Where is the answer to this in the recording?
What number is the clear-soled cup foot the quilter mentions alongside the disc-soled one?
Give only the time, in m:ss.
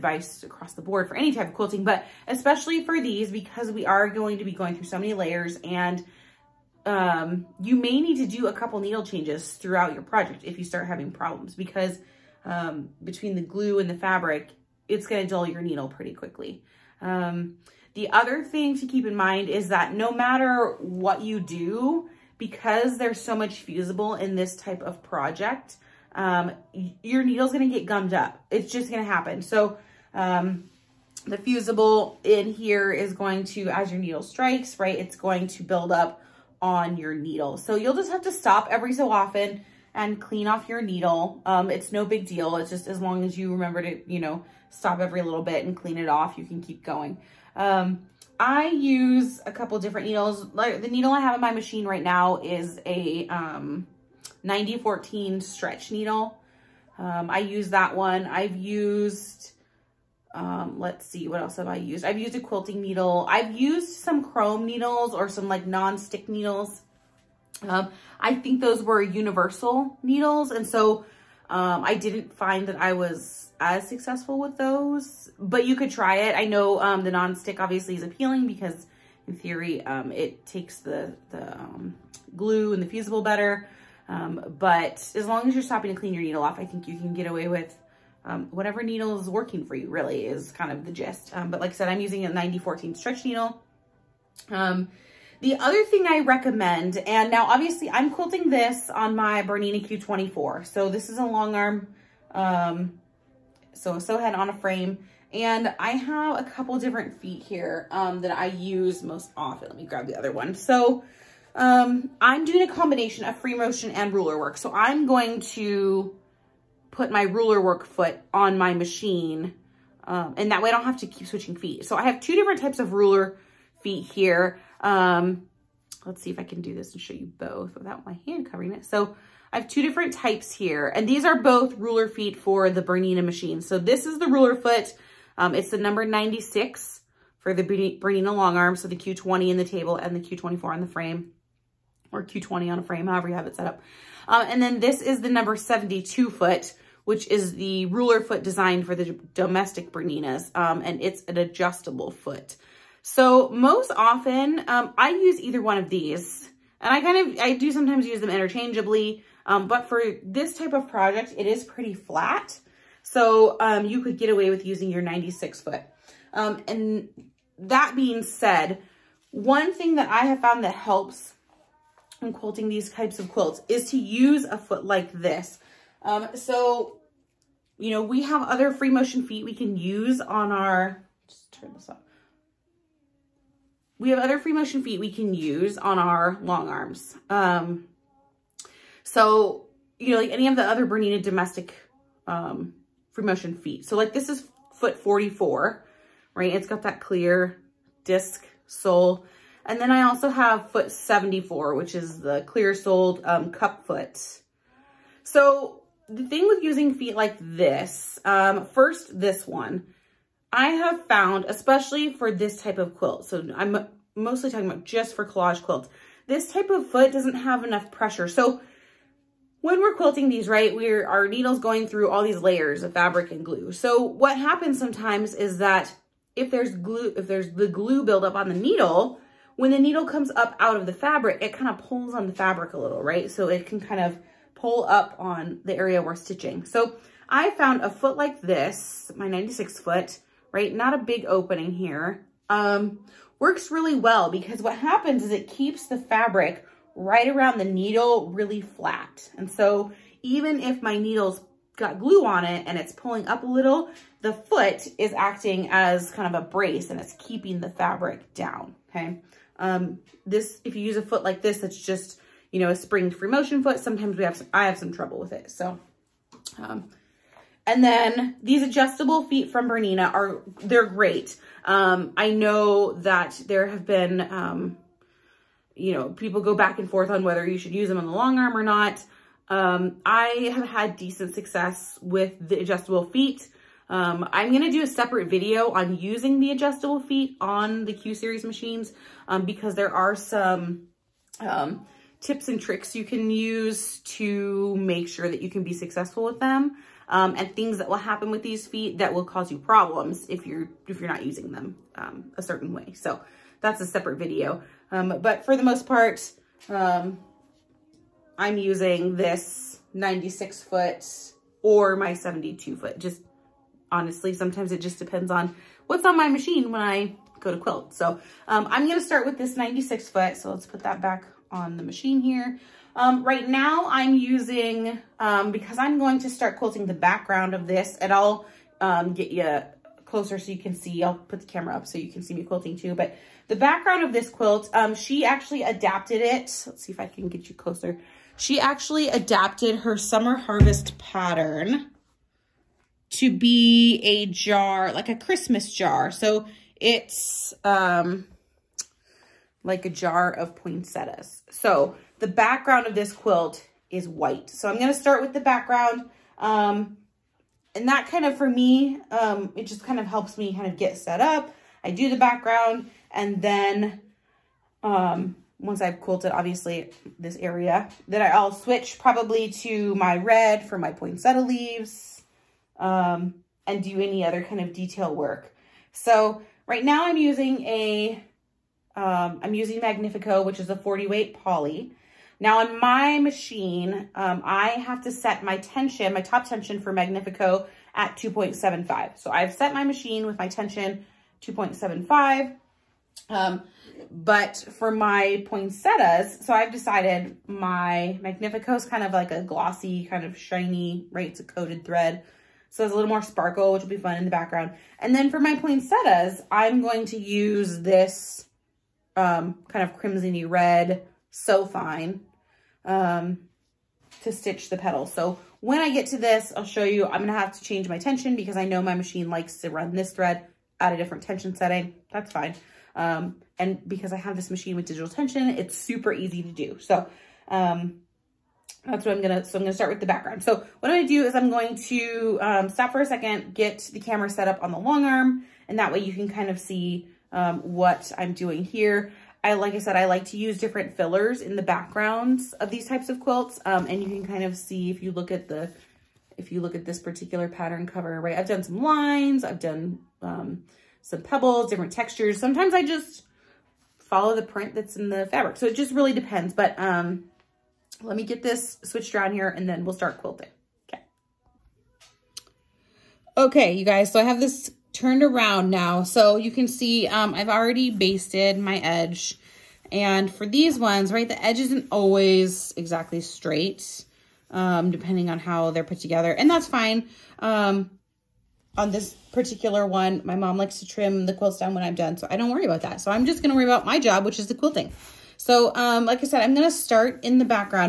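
3:20.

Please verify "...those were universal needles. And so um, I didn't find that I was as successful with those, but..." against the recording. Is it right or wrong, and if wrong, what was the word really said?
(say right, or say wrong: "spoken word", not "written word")
right.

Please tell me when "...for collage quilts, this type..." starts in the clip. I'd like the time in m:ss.
3:35.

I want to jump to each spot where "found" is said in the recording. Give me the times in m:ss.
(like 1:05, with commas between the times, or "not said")
2:50, 3:31, 3:57.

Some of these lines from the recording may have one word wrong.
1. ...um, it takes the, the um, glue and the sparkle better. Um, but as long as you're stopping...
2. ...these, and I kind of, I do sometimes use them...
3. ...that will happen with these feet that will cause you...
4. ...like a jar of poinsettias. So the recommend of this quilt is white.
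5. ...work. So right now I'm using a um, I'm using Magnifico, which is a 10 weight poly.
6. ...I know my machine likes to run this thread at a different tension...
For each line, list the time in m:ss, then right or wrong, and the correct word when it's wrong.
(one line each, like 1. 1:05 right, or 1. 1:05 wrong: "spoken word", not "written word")
1. 1:19 wrong: "fusible", not "sparkle"
2. 2:35 right
3. 4:57 right
4. 5:49 wrong: "background", not "recommend"
5. 6:15 wrong: "40", not "10"
6. 6:58 right.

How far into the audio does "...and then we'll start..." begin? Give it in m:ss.
7:39.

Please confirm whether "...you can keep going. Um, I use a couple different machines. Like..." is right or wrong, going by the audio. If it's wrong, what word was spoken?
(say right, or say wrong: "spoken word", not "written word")
wrong: "needles", not "machines".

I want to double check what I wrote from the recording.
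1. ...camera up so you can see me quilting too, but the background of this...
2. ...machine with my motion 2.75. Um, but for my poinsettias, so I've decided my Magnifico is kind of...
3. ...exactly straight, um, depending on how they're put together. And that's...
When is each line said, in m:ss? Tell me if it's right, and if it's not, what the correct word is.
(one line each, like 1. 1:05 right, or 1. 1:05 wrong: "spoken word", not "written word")
1. 5:31 right
2. 6:29 wrong: "tension", not "motion"
3. 7:52 right.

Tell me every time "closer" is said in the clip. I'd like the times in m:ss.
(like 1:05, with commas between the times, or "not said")
5:30, 5:37.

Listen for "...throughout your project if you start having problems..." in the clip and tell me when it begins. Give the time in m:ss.
0:09.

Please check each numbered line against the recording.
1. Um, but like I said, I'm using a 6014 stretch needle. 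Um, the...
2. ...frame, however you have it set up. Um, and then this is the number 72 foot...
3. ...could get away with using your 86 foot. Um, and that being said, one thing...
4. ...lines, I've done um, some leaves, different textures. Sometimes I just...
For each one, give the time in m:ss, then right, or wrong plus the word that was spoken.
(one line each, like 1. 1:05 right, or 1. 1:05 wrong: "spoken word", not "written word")
1. 1:31 wrong: "9014", not "6014"
2. 2:22 right
3. 2:44 wrong: "96", not "86"
4. 7:28 wrong: "pebbles", not "leaves".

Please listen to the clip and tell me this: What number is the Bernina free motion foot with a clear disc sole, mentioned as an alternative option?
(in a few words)
44.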